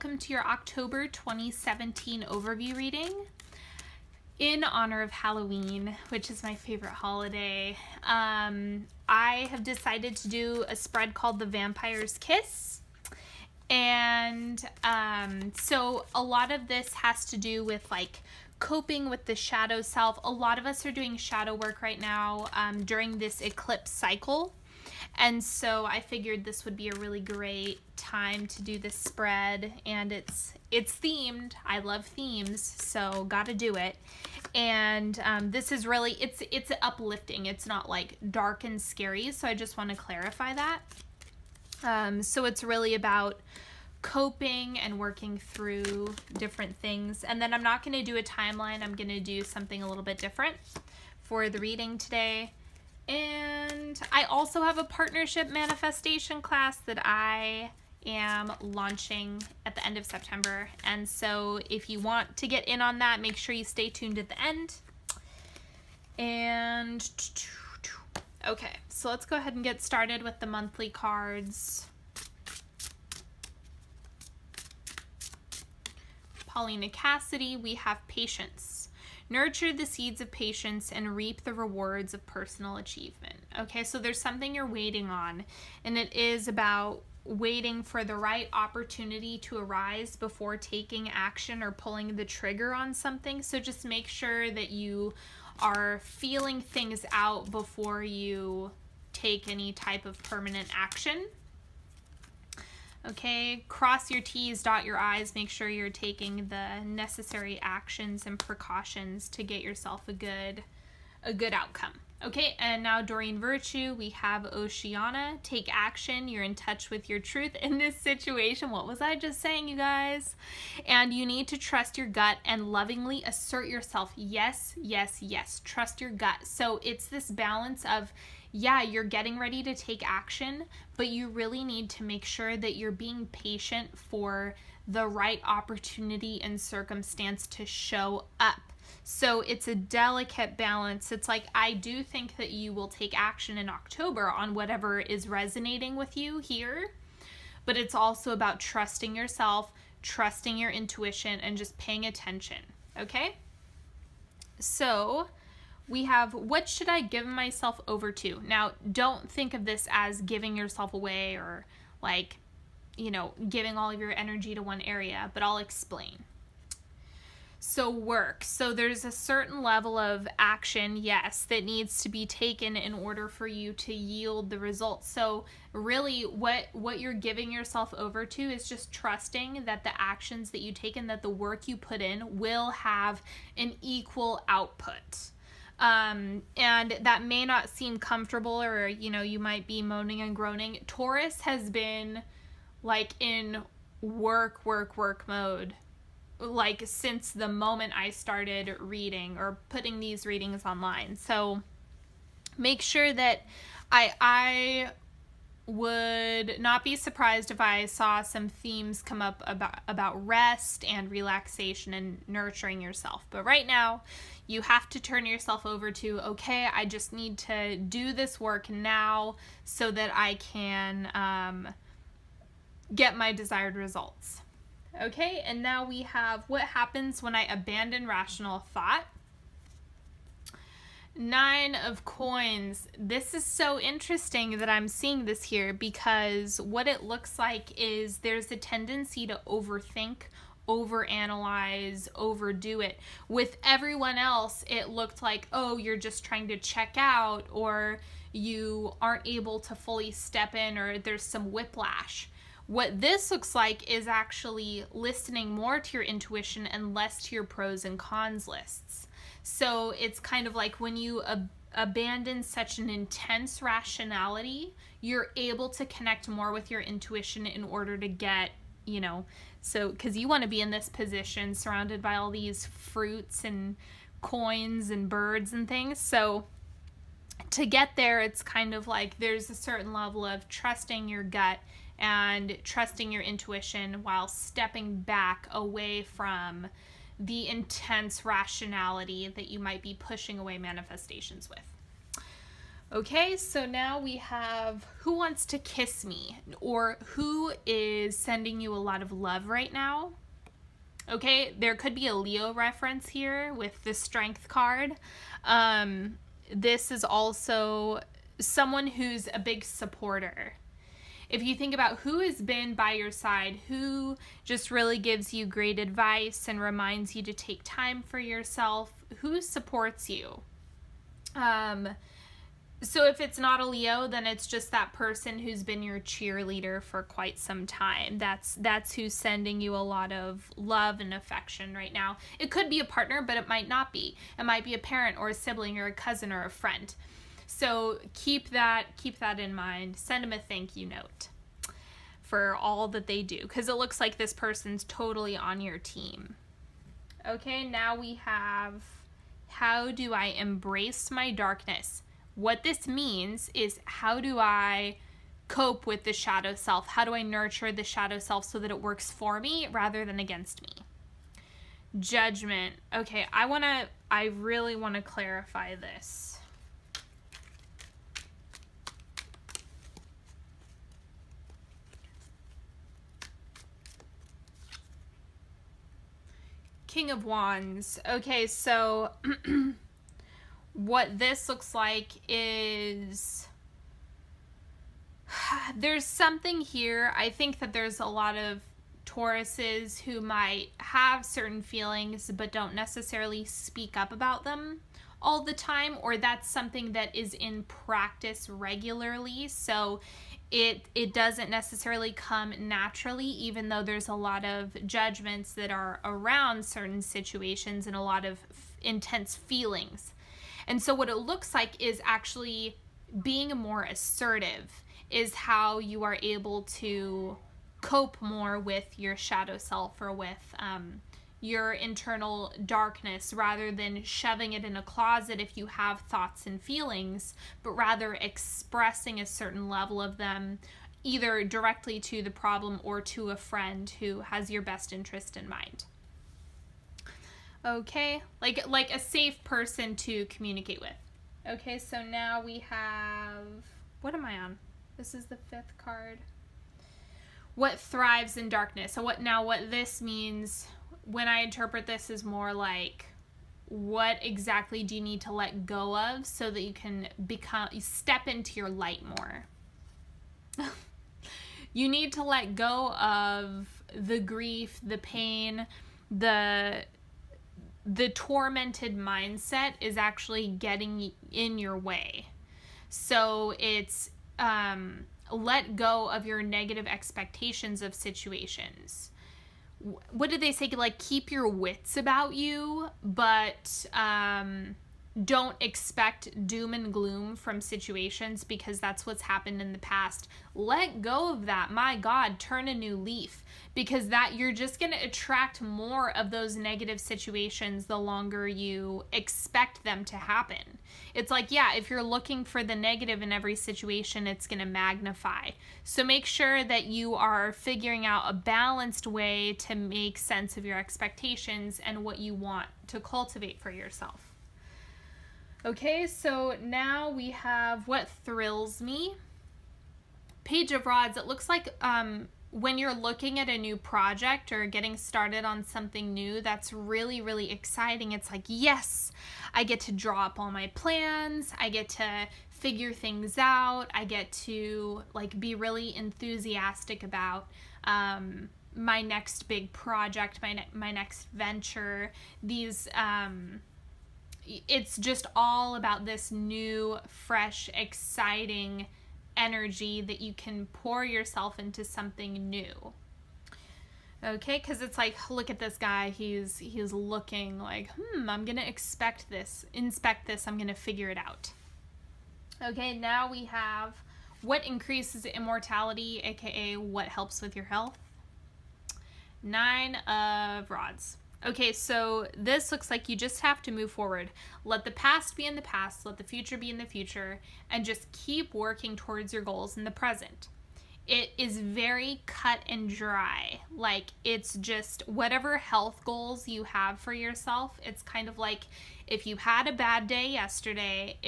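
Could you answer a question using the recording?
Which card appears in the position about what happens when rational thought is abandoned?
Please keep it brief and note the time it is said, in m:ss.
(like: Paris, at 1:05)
Nine of coins, at 3:51.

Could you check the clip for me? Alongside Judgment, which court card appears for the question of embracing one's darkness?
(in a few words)
King of Wands.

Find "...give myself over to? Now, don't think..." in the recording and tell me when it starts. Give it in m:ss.
2:37.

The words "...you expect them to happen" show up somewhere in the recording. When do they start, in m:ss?
8:18.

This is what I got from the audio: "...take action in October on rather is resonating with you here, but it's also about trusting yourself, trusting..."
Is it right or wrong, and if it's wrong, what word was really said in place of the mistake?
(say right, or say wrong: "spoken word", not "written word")
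wrong: "whatever", not "rather".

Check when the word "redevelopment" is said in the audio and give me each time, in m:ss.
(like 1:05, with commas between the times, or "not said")
not said.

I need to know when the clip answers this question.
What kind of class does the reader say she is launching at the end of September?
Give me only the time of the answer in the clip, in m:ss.
0:54.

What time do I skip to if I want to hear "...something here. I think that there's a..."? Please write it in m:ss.
6:26.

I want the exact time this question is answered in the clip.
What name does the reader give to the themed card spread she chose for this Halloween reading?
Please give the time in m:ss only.
0:11.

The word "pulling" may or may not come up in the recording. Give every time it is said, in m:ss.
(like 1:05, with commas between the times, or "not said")
1:31.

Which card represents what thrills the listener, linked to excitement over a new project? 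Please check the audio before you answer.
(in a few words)
Page of Rods.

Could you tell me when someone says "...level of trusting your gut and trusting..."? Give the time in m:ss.
4:39.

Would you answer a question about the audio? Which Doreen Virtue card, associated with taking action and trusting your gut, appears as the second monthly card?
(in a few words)
Oceana.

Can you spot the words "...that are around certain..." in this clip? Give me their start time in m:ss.
6:45.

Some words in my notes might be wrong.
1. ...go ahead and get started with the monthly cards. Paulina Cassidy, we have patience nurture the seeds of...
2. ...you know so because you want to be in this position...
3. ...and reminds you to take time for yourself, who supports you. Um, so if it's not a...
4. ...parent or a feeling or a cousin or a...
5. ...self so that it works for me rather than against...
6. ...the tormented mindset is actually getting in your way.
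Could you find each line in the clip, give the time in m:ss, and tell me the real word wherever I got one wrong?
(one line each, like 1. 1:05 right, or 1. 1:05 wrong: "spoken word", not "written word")
1. 1:09 right
2. 4:28 right
3. 5:16 right
4. 5:34 wrong: "sibling", not "feeling"
5. 5:58 right
6. 7:47 right.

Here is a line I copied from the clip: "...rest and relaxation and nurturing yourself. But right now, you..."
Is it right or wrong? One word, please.
right.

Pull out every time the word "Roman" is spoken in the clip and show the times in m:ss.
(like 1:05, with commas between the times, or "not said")
not said.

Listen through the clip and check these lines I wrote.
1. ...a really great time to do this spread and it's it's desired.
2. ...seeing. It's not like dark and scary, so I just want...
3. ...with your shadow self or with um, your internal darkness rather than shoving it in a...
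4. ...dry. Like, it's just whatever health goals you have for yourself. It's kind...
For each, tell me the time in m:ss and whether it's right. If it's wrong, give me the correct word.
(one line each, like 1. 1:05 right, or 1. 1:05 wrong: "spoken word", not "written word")
1. 0:26 wrong: "themed", not "desired"
2. 0:36 wrong: "uplifting", not "seeing"
3. 6:58 right
4. 9:42 right.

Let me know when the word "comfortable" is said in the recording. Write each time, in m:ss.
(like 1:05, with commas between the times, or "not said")
3:07.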